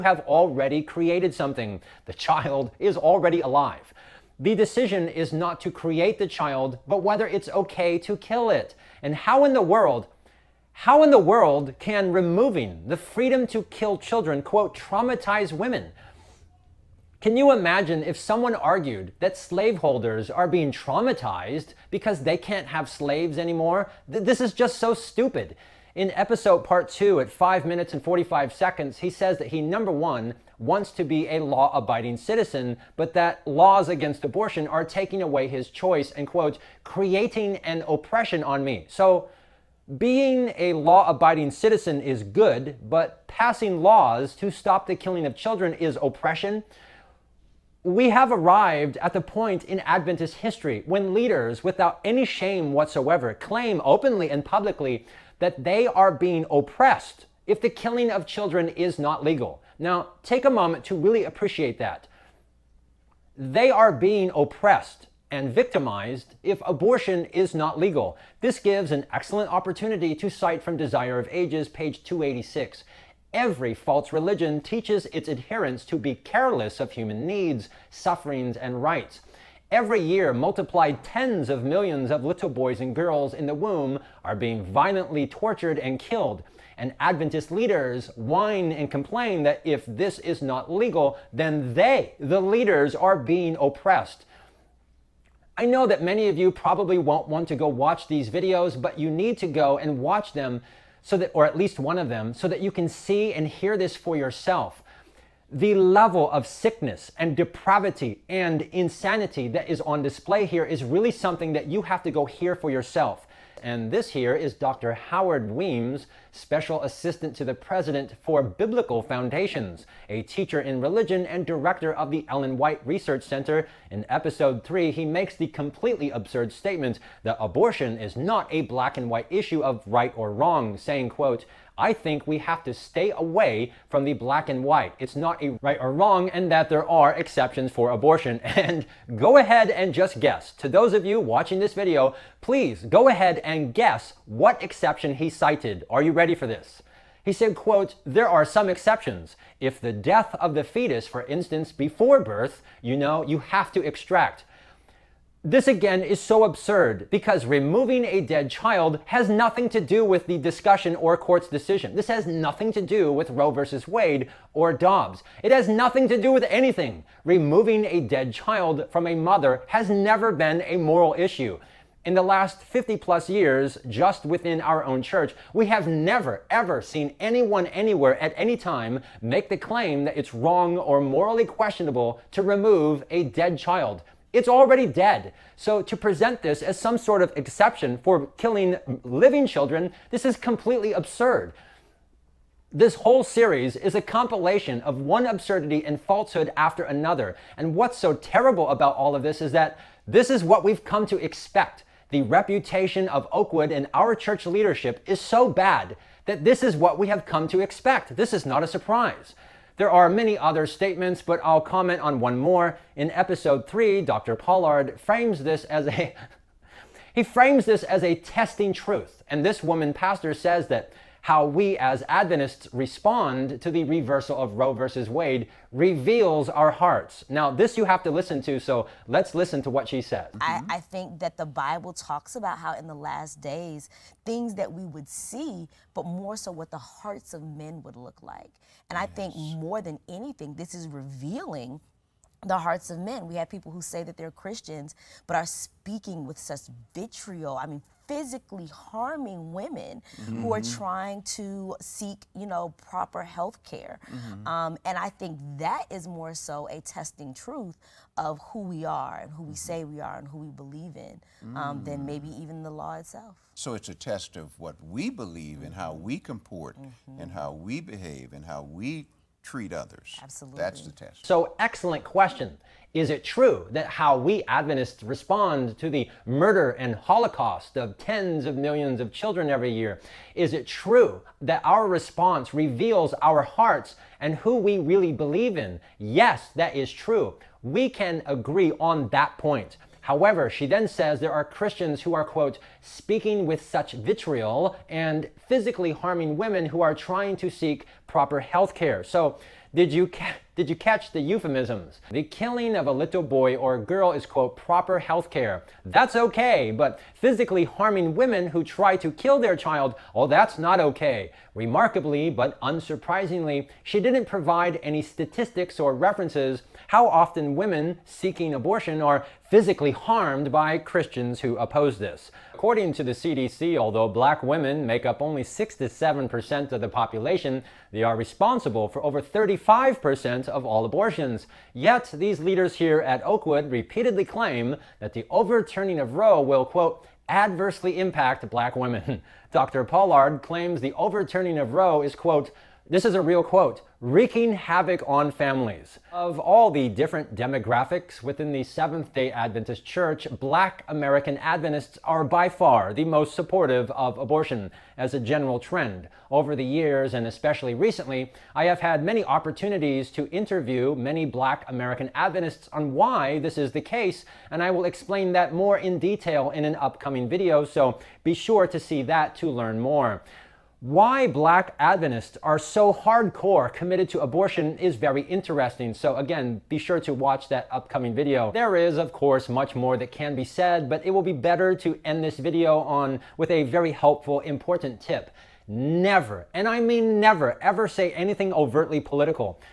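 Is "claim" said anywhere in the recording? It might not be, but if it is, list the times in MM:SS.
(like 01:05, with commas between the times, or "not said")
00:53, 02:59, 05:34, 05:40.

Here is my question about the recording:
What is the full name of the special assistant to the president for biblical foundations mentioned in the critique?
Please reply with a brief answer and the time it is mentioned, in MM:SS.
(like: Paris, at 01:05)
Howard Weems, at 01:54.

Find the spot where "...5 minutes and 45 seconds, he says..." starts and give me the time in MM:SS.
00:27.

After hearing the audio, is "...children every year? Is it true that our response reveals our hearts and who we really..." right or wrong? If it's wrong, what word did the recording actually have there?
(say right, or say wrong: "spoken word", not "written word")
right.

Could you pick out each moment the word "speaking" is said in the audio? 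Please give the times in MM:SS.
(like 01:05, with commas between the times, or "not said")
04:05, 04:52.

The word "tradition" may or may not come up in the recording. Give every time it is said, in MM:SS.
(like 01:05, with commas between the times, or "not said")
not said.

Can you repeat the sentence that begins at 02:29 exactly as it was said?
If the death of the fetus, for instance, before birth, you know, you have to extract.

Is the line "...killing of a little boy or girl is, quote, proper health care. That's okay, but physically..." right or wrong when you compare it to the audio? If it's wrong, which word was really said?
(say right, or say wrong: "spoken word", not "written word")
right.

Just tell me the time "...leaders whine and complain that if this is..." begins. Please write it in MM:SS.
01:27.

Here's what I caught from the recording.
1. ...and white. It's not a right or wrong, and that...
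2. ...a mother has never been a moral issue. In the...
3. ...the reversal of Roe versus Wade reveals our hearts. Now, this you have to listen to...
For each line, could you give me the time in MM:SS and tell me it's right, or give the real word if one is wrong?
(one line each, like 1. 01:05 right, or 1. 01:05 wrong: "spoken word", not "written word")
1. 02:14 right
2. 02:49 right
3. 03:43 right.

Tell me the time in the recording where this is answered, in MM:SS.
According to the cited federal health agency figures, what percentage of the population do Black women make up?
05:25.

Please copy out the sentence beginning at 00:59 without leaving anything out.
Now, take a moment to really appreciate that.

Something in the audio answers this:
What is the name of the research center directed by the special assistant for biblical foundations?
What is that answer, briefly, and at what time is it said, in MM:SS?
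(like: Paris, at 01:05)
Ellen White Research Center, at 02:02.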